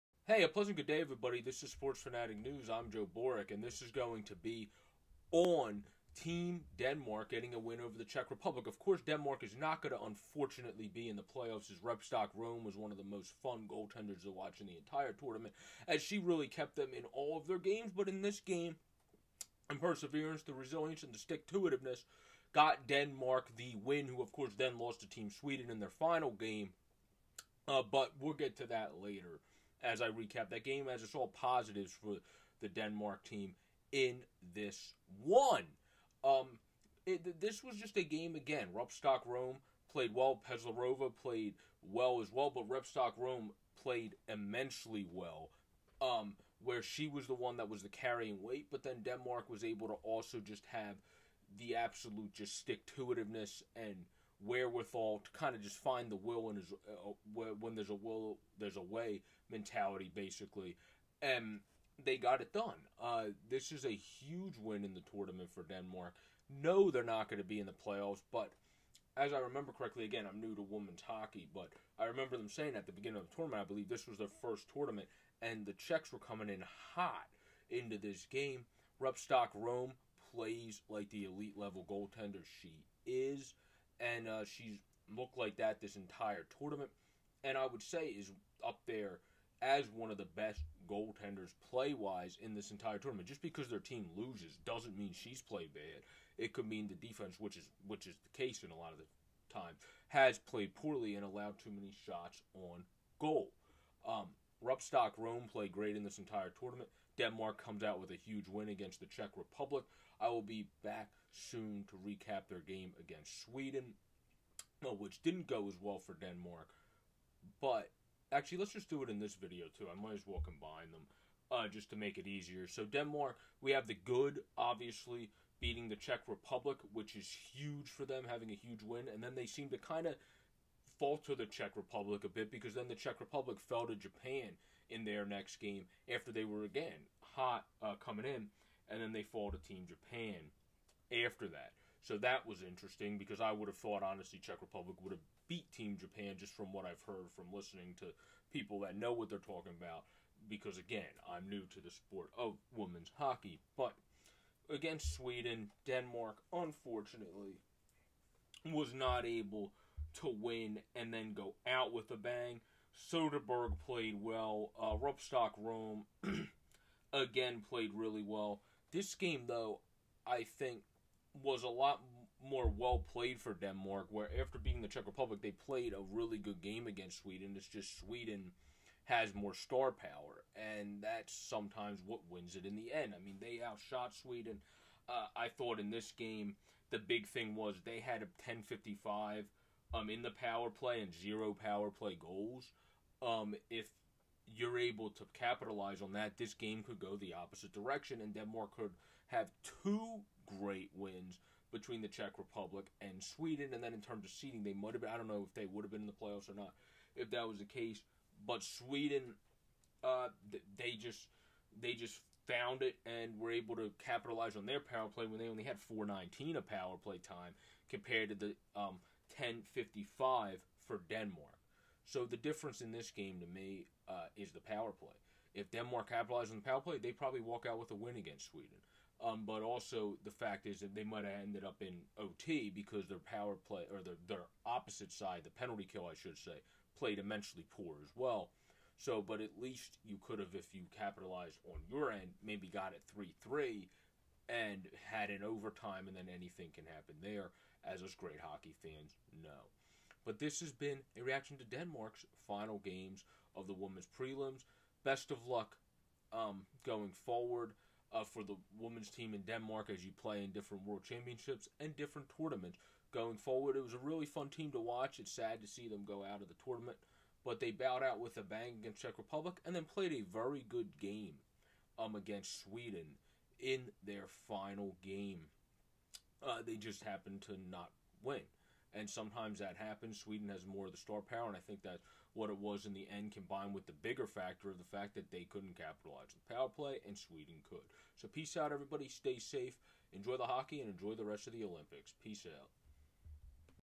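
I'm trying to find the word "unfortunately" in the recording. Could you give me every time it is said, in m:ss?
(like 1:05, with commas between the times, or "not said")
0:10, 2:36.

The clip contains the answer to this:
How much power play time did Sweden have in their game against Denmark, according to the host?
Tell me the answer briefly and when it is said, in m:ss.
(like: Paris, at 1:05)
4:19, at 3:35.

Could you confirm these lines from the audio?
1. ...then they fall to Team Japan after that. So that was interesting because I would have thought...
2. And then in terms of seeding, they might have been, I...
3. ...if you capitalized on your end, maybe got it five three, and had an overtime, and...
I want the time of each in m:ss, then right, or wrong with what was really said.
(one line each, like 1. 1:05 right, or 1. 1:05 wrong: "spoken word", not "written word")
1. 2:19 right
2. 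3:23 right
3. 4:00 wrong: "three", not "five".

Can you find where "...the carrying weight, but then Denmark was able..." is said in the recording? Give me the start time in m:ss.
0:47.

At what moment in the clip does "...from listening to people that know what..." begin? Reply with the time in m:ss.
2:27.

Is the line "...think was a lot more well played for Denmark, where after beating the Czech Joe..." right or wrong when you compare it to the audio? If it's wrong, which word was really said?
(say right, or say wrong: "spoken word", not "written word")
wrong: "Republic", not "Joe".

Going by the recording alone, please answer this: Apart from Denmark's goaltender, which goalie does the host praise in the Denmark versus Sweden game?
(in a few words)
Soderberg.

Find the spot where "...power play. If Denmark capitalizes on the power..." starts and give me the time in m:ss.
3:44.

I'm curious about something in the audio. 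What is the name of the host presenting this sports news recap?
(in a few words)
Joe Boric.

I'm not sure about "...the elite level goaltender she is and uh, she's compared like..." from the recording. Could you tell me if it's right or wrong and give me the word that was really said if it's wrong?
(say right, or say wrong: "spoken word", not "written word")
wrong: "looked", not "compared".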